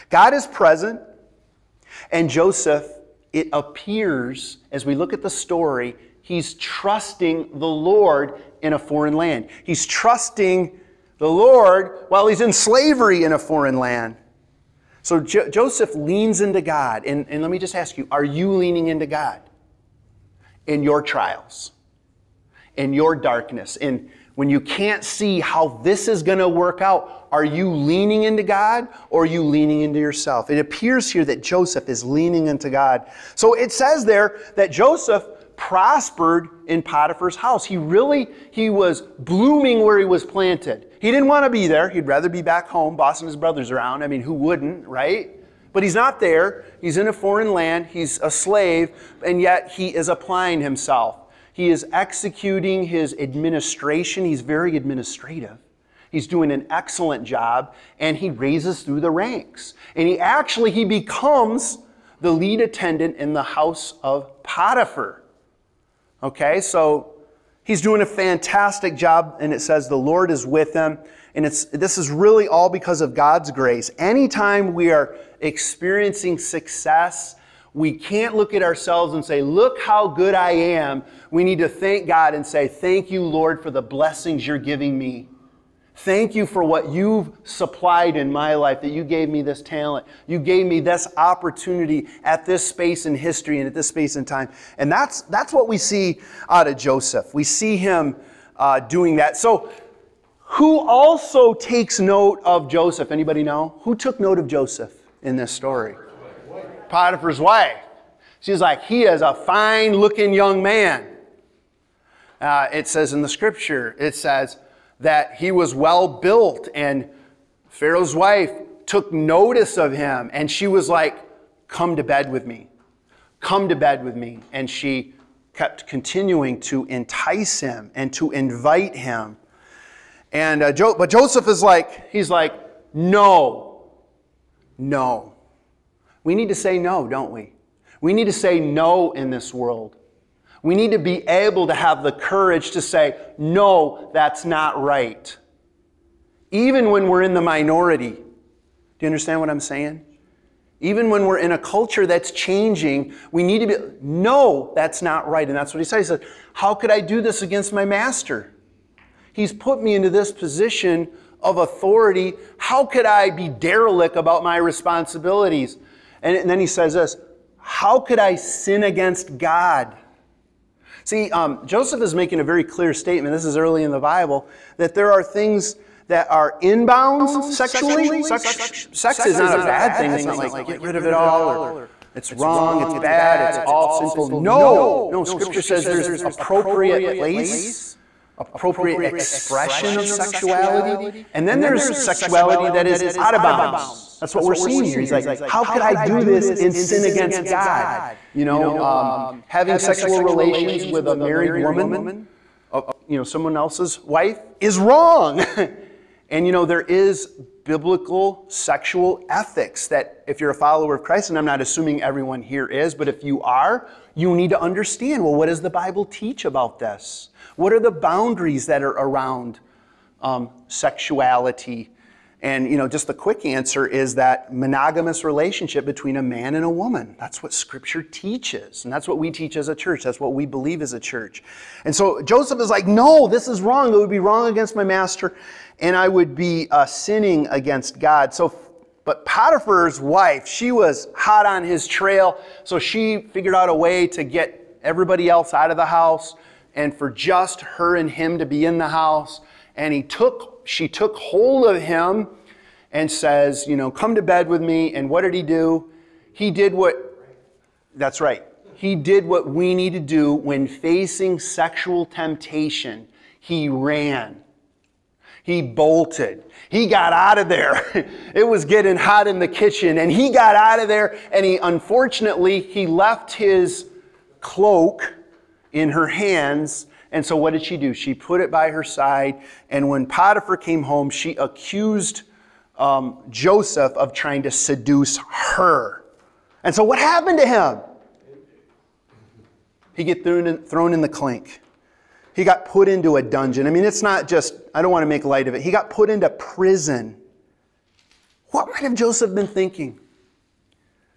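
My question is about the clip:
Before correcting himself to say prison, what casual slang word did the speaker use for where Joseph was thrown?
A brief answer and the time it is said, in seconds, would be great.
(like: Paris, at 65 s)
the clink, at 291 s.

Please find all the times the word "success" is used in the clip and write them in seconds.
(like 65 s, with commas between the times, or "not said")
76 s.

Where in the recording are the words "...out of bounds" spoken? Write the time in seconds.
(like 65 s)
193 s.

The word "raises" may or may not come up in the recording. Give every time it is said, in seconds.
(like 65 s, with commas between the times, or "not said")
58 s.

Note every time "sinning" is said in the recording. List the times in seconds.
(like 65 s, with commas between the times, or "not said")
236 s.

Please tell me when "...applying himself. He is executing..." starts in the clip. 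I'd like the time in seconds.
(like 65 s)
50 s.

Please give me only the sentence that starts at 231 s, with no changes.
And so Joseph is like, no, this is wrong.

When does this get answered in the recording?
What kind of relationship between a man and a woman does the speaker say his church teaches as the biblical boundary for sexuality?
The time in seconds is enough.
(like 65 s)
224 s.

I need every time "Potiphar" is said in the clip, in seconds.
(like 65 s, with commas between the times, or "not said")
36 s, 64 s, 106 s, 239 s, 280 s.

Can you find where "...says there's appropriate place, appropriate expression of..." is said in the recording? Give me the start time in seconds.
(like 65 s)
185 s.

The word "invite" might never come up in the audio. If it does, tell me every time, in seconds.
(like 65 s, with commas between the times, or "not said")
128 s.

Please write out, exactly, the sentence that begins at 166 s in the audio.
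And, and then he says this How could I sin against God?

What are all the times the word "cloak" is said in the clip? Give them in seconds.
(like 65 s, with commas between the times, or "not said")
274 s.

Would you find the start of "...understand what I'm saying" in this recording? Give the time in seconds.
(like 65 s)
149 s.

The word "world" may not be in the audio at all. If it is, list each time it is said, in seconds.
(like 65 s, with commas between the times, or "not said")
139 s.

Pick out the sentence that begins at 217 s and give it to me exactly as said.
What are the boundaries that are around um, sexuality?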